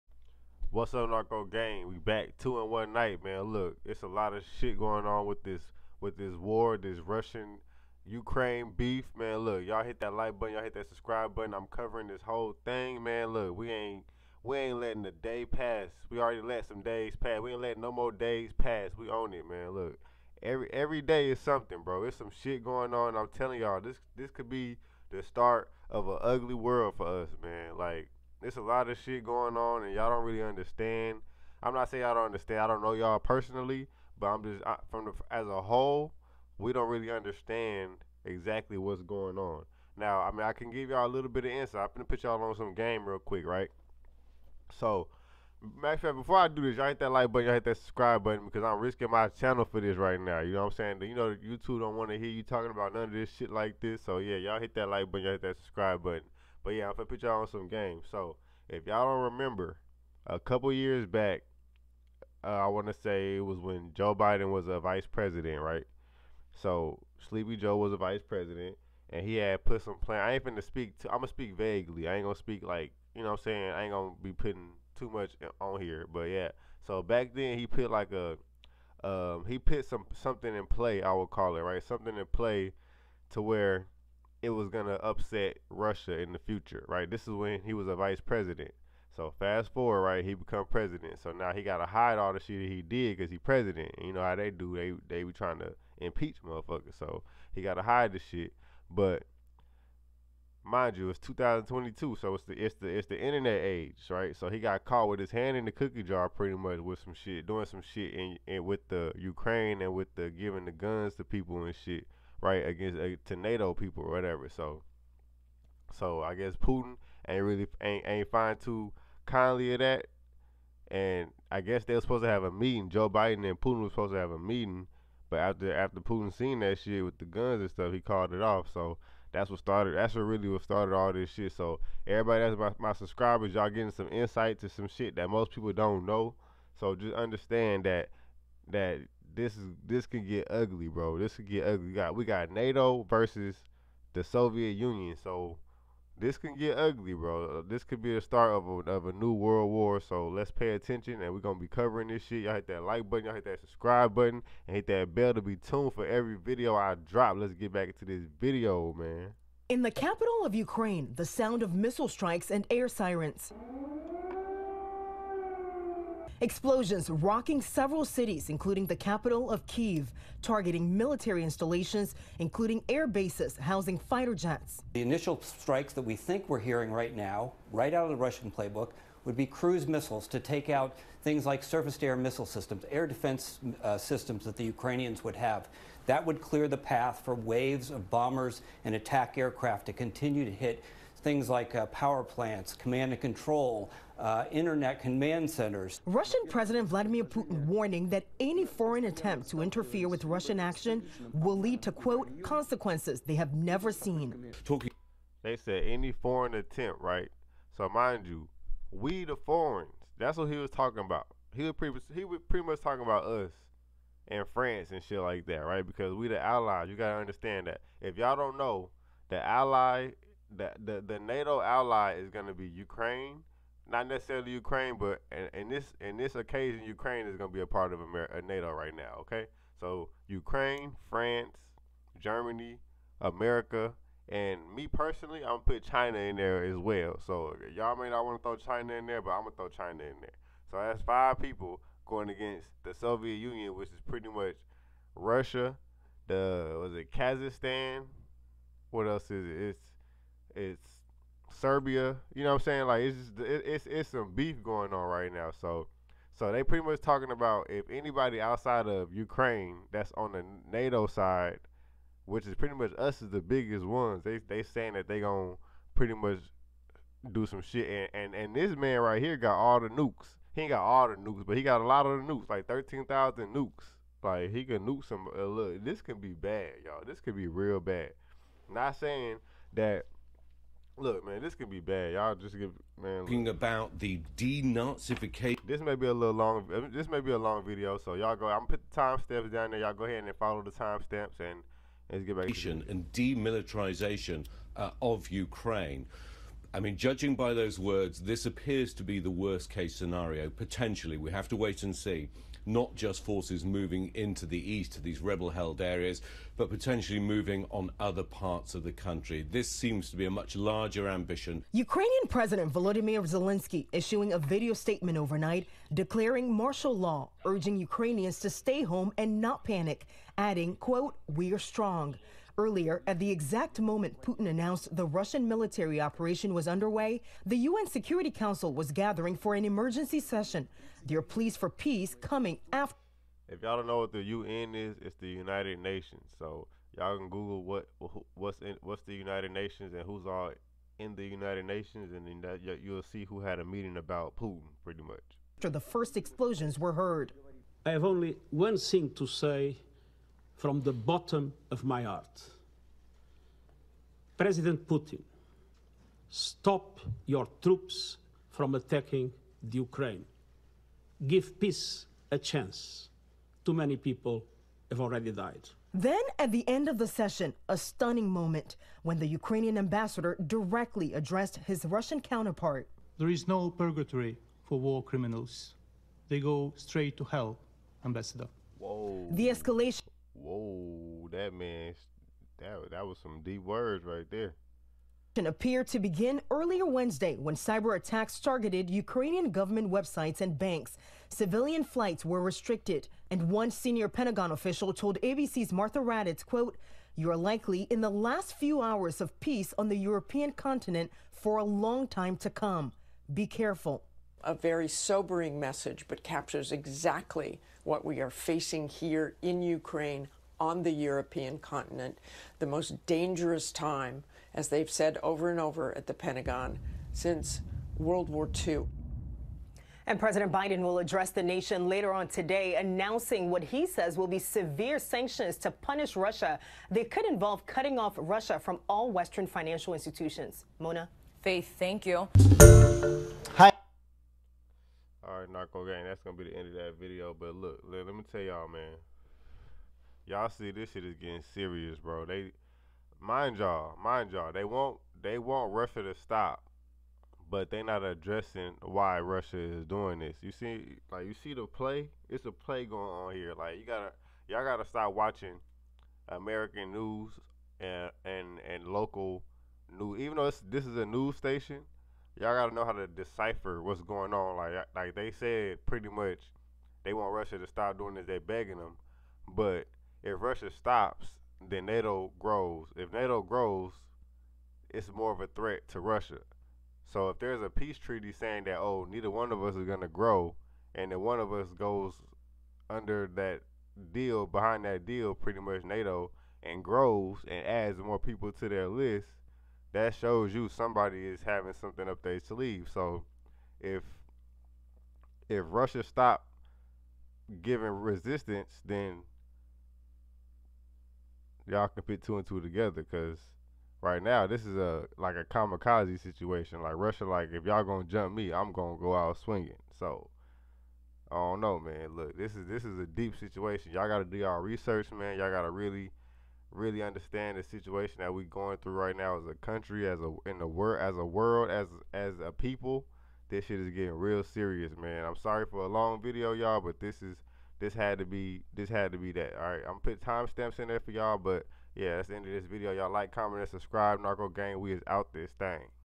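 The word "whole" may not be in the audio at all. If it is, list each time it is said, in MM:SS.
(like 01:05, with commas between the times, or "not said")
00:12, 00:35.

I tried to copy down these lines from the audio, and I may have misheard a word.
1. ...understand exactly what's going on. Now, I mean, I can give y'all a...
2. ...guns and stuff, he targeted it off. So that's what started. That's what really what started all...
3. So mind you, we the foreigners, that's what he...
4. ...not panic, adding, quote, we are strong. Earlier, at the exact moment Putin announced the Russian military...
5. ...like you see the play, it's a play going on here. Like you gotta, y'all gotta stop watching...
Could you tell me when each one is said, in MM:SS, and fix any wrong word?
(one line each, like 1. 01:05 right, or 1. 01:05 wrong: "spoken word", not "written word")
1. 00:37 right
2. 02:07 wrong: "called", not "targeted"
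3. 03:27 right
4. 05:19 right
5. 07:31 right.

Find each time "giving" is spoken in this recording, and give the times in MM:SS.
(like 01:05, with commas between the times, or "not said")
01:50, 08:17.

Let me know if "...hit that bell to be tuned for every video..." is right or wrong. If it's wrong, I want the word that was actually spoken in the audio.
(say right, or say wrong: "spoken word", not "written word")
right.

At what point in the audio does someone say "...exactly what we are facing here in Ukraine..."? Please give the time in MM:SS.
06:46.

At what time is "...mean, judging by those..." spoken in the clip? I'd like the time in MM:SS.
04:56.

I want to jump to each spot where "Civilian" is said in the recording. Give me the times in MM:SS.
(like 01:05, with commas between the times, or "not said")
06:31.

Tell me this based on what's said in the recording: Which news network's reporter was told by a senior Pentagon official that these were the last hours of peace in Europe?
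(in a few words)
ABC.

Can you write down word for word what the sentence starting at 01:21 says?
I would call it right, something in play to where it was going to upset Russia in the future, right?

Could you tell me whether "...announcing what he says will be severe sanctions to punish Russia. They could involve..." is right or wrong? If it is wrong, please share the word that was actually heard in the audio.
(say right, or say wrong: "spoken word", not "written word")
right.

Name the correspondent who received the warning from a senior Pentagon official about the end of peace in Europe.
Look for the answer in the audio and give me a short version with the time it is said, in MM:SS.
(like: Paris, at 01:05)
Martha Raddatz, at 06:35.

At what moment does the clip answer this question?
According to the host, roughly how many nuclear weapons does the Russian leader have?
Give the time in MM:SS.
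04:32.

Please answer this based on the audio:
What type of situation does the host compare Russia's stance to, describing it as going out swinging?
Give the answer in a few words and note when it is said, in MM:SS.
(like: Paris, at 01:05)
Kamikaze situation, at 08:25.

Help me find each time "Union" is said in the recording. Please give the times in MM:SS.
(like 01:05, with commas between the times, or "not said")
02:24, 04:03.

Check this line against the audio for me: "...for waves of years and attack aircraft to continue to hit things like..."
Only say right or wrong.
wrong.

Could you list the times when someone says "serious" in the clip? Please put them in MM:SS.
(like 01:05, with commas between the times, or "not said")
07:21, 08:44.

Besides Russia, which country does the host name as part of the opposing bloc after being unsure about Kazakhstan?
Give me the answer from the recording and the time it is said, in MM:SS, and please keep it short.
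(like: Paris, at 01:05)
Serbia, at 04:11.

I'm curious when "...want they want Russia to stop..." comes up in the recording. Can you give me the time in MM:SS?
07:24.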